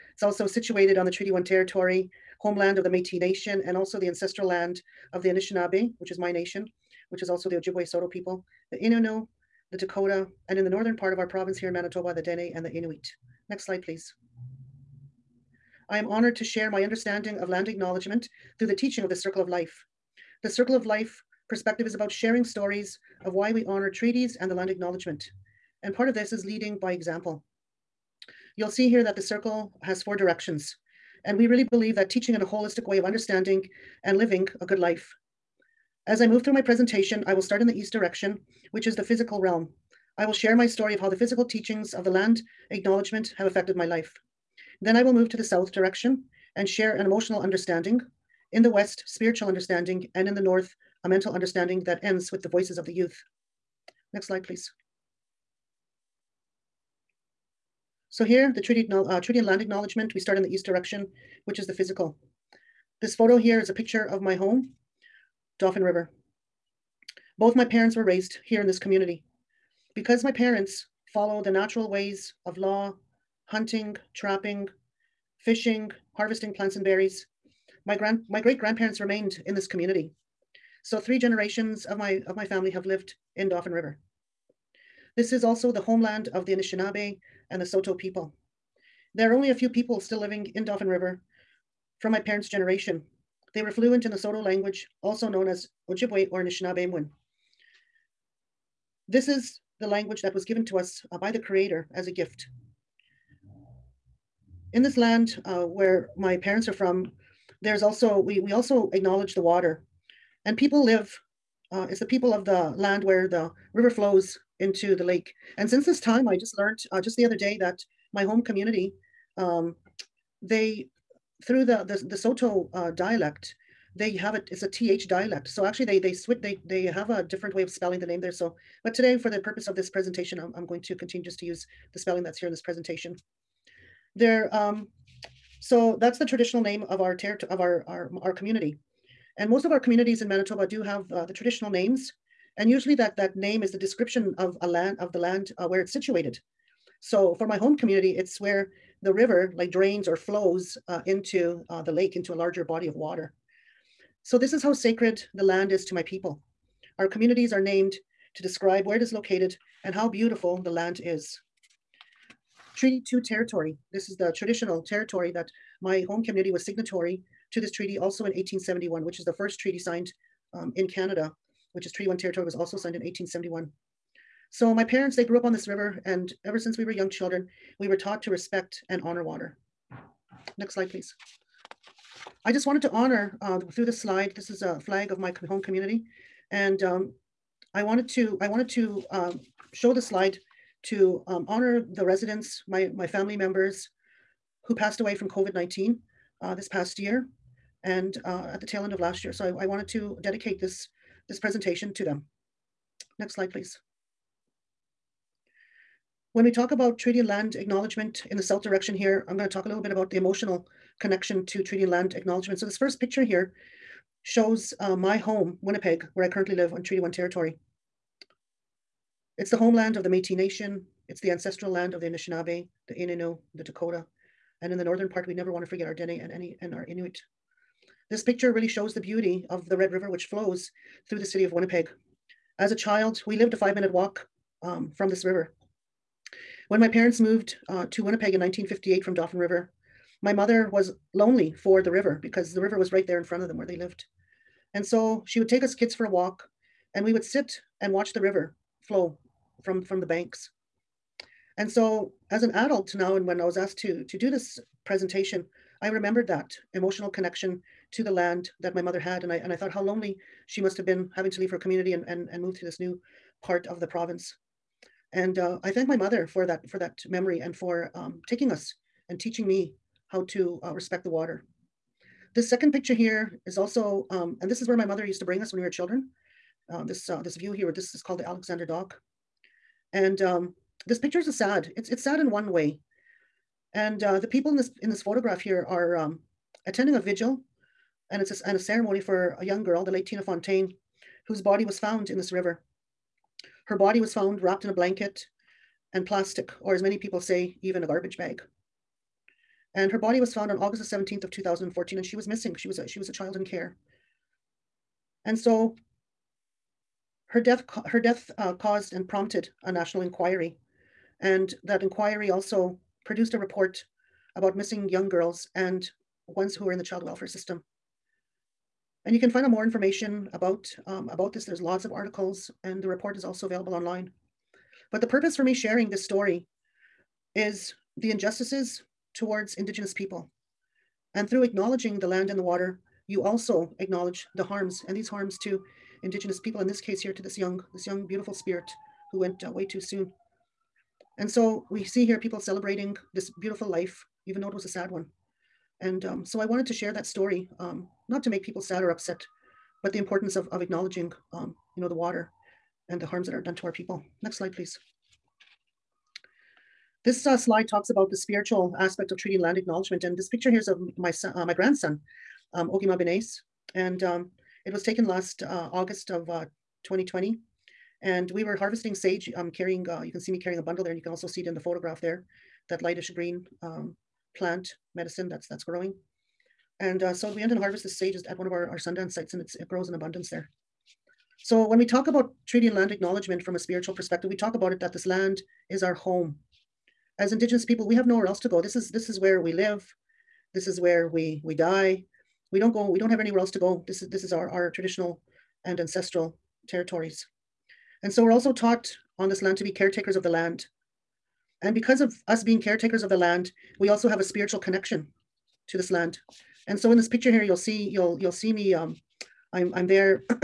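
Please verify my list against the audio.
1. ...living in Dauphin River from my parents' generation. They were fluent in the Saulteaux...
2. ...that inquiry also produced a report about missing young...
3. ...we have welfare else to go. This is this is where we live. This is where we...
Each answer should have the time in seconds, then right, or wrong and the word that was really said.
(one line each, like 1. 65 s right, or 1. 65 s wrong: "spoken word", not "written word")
1. 90 s right
2. 311 s right
3. 387 s wrong: "nowhere", not "welfare".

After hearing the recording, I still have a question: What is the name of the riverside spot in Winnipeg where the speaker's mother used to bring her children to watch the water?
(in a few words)
Alexander Dock.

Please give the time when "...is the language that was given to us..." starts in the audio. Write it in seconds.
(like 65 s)
99 s.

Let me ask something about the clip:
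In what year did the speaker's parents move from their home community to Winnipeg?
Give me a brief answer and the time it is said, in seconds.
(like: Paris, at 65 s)
1958, at 238 s.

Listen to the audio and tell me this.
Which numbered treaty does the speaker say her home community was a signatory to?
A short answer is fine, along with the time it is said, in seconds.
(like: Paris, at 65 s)
Treaty 2, at 162 s.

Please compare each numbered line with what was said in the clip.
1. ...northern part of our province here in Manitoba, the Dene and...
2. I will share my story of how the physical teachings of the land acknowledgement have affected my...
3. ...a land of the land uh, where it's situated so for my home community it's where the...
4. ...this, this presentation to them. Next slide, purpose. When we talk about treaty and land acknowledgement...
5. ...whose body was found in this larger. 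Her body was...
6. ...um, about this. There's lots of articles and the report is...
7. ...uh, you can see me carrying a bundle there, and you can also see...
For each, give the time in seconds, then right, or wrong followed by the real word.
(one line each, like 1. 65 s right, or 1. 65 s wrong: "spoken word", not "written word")
1. 10 s right
2. 40 s right
3. 144 s right
4. 200 s wrong: "please", not "purpose"
5. 291 s wrong: "river", not "larger"
6. 320 s right
7. 369 s right.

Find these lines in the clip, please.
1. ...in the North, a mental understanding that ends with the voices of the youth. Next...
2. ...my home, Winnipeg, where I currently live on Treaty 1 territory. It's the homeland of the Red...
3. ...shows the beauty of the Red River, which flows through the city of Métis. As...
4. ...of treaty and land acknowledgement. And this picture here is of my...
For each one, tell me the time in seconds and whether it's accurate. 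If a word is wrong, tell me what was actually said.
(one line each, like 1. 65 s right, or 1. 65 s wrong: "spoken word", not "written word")
1. 50 s right
2. 214 s wrong: "Métis", not "Red"
3. 228 s wrong: "Winnipeg", not "Métis"
4. 359 s right.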